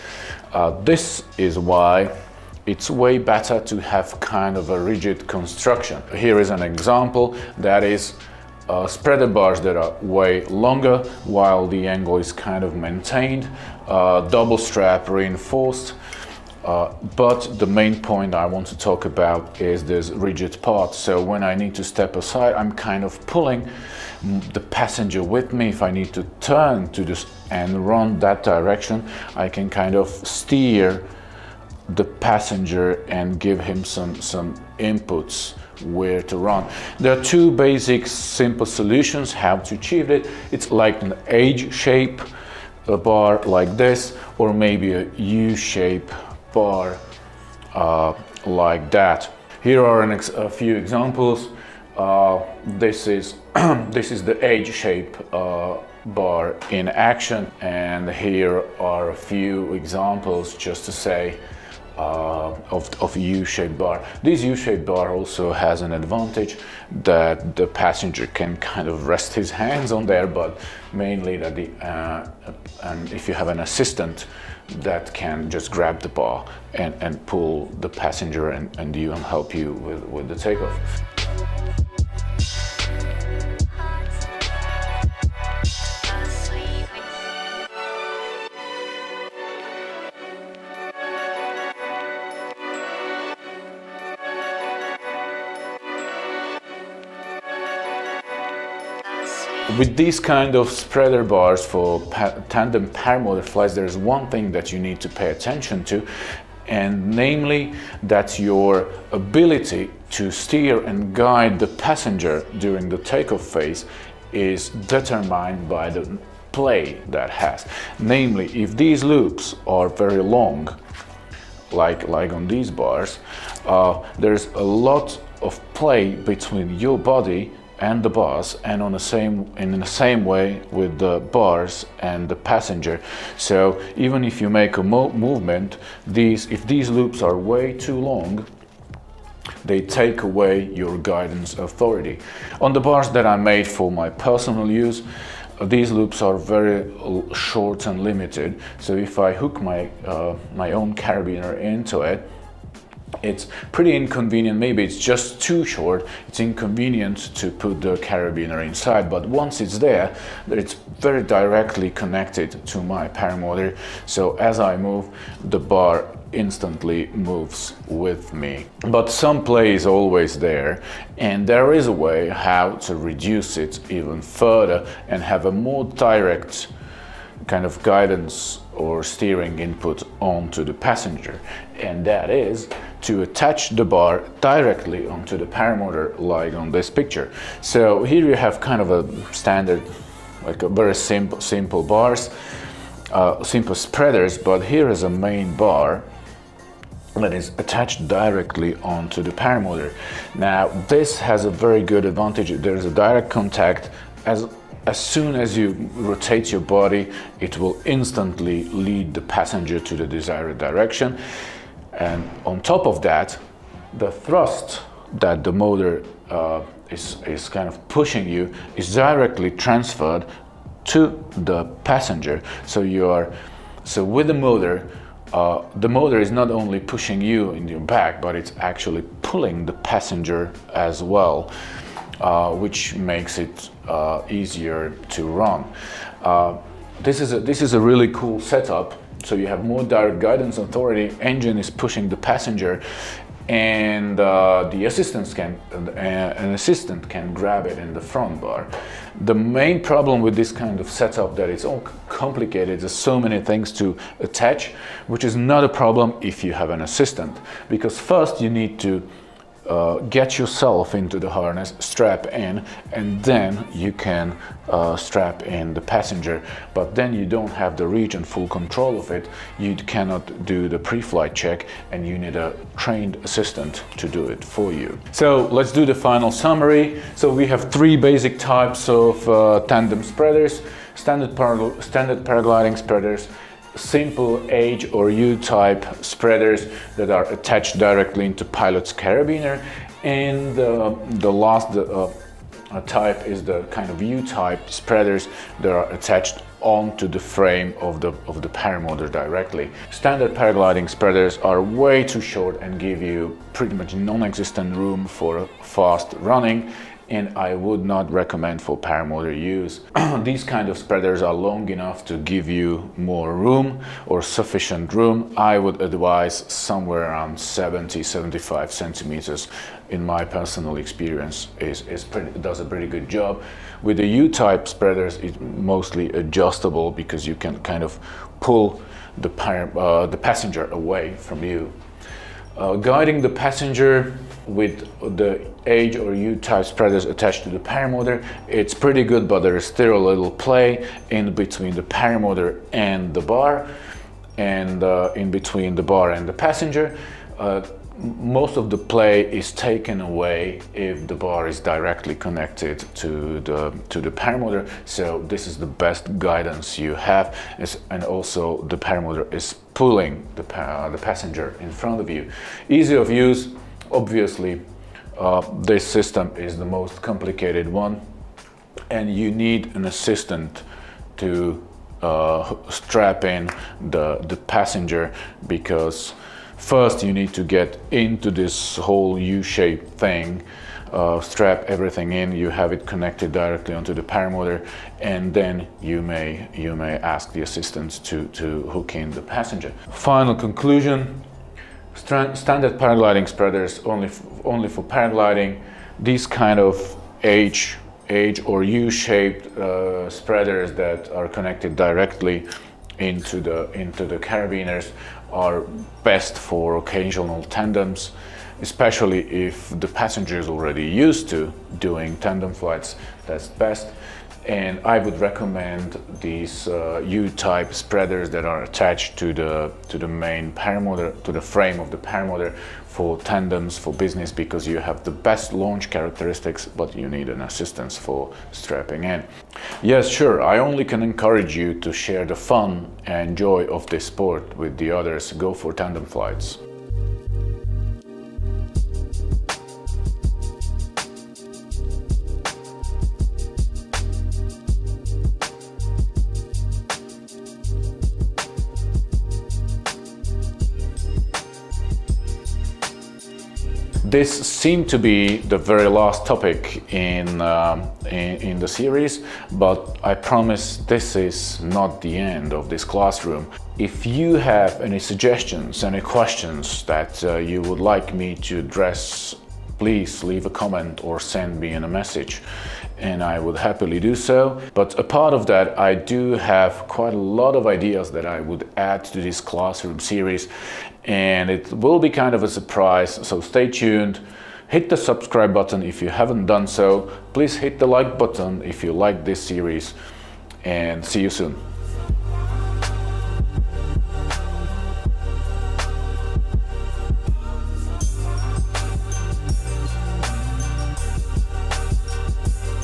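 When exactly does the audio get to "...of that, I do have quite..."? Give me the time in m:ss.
7:55.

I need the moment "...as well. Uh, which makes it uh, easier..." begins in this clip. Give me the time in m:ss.
3:50.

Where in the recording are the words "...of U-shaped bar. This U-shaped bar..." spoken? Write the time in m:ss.
1:03.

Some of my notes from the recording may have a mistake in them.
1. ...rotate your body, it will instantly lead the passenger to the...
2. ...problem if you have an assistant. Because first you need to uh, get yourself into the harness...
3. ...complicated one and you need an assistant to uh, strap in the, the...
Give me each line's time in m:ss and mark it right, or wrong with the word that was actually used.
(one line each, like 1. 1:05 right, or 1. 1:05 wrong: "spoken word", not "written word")
1. 3:25 right
2. 4:15 right
3. 6:07 right.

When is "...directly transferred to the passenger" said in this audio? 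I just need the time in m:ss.
3:38.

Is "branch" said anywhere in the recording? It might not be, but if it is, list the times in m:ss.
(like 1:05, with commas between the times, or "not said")
not said.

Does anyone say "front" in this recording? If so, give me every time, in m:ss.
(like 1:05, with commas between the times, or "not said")
4:08, 6:01.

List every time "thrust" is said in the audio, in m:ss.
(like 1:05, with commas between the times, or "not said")
3:34.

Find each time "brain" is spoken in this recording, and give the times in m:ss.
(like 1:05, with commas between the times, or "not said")
not said.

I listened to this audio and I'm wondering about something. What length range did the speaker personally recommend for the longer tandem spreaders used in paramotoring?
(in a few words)
70-75 centimeters.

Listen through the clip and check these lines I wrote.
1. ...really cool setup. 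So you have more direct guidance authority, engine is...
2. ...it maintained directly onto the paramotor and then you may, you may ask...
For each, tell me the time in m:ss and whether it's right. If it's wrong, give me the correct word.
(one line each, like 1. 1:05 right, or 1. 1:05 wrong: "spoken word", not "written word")
1. 3:57 right
2. 6:22 wrong: "connected", not "maintained".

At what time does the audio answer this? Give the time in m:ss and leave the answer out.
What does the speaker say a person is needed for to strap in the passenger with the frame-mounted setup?
4:32.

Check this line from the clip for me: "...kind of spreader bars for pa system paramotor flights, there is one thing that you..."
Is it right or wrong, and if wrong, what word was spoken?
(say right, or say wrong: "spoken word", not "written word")
wrong: "tandem", not "system".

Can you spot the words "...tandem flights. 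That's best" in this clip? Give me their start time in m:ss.
6:52.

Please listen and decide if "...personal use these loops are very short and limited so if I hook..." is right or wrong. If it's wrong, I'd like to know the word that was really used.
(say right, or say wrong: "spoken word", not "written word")
right.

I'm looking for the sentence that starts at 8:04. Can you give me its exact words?
Hit the subscribe button if you haven't done so.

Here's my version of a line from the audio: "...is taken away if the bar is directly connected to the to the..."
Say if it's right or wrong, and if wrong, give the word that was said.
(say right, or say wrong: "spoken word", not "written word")
right.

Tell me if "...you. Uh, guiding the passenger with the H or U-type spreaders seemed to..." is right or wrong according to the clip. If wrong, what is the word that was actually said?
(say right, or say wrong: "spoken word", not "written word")
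wrong: "attached", not "seemed".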